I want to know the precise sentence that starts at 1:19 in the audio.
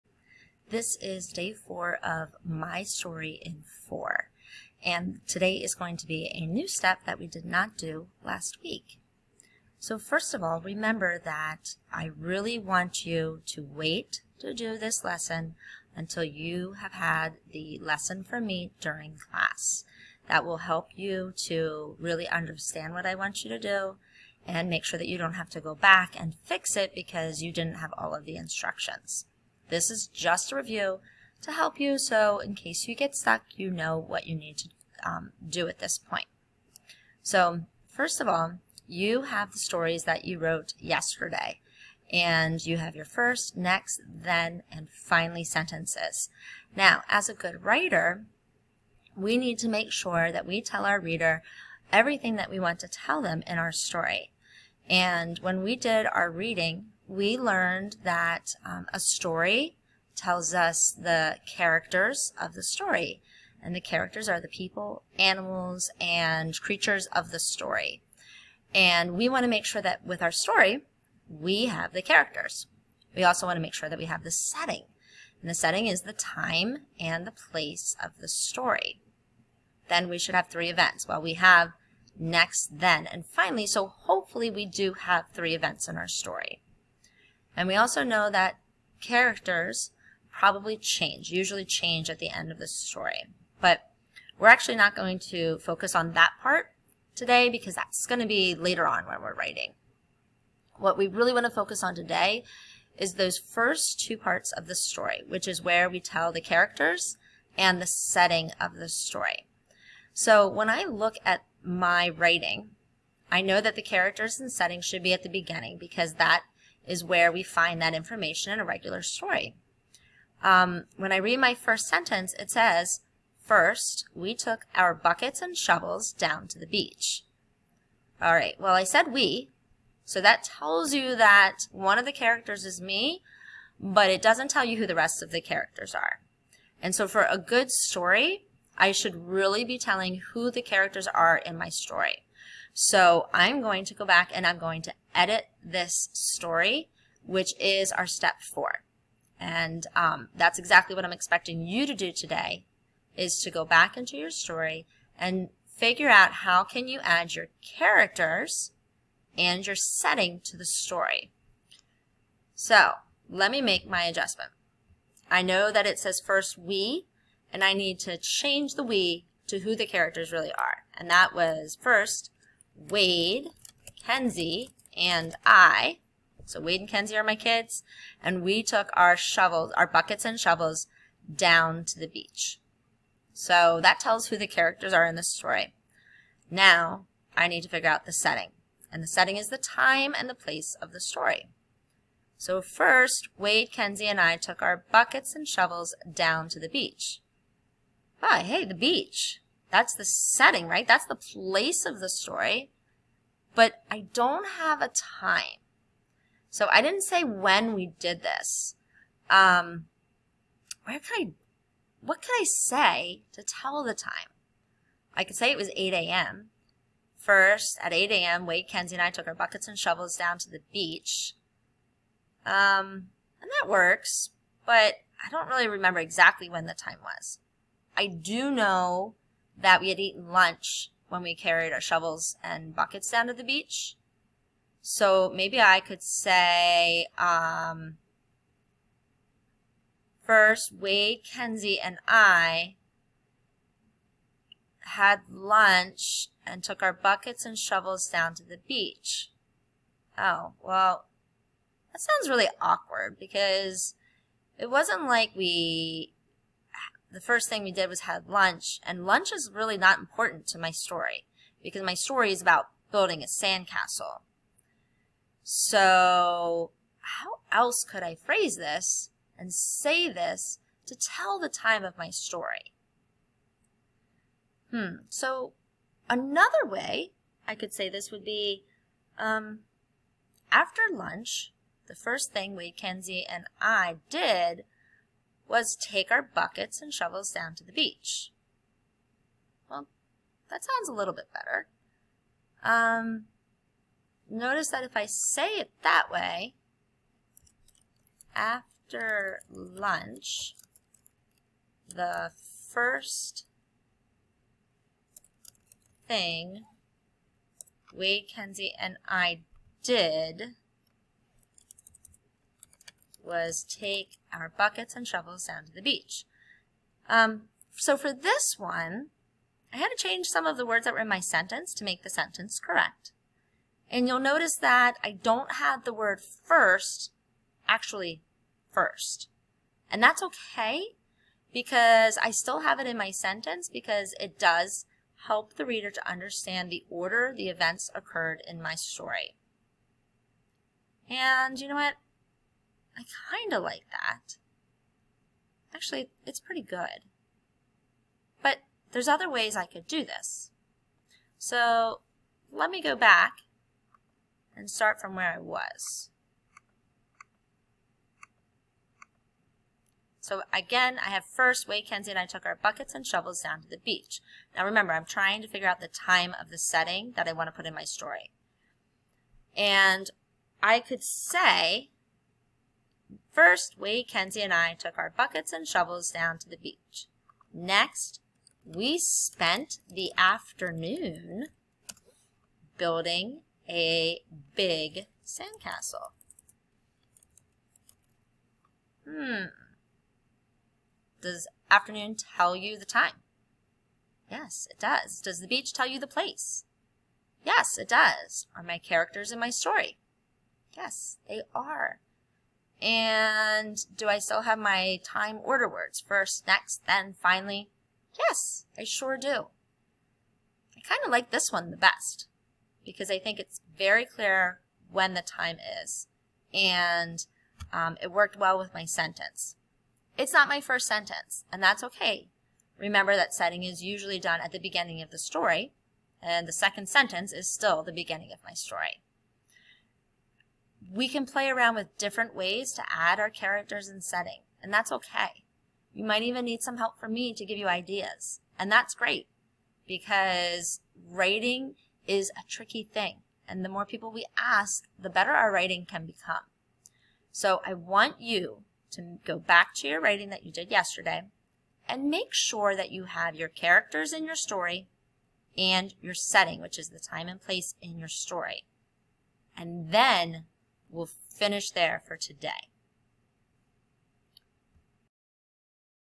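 Then we should have three events.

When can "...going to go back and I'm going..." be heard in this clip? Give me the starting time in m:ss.
2:23.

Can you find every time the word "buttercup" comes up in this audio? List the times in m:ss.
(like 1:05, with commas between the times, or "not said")
not said.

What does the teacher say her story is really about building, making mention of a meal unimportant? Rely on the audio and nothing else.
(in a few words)
a sandcastle.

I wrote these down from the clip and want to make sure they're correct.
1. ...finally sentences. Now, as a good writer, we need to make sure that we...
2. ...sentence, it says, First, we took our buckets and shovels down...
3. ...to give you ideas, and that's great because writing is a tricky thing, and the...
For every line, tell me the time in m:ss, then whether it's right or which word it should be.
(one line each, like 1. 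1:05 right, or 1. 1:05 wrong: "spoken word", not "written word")
1. 0:44 right
2. 2:01 right
3. 7:17 right.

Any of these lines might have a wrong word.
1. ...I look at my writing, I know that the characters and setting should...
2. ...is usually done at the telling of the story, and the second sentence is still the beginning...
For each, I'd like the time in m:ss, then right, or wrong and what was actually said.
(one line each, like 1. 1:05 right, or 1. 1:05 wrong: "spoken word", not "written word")
1. 1:50 right
2. 7:03 wrong: "beginning", not "telling".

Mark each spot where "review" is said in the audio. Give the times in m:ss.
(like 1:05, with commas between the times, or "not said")
0:30.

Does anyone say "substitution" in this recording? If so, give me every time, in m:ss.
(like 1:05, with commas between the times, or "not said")
not said.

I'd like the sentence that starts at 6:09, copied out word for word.
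And I could say First, we, Kenzie, and I took our buckets and shovels down to the beach.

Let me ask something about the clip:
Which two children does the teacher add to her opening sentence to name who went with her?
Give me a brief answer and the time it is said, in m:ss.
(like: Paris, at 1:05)
Wade and Kenzie, at 2:56.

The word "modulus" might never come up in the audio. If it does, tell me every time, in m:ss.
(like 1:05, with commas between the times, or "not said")
not said.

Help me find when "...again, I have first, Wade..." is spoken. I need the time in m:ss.
6:00.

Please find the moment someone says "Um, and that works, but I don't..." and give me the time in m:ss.
3:42.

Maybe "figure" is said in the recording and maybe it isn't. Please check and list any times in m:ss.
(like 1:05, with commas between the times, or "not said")
2:35, 3:07, 6:05.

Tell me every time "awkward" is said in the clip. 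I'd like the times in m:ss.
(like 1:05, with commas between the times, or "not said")
4:12.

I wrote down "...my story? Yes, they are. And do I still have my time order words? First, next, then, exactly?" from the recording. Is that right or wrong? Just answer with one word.
wrong.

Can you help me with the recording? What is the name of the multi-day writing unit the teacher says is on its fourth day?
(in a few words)
My Story in Four.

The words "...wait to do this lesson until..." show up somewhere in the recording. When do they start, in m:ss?
0:13.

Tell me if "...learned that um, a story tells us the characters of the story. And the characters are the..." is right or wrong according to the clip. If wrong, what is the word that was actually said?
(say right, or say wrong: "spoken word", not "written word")
right.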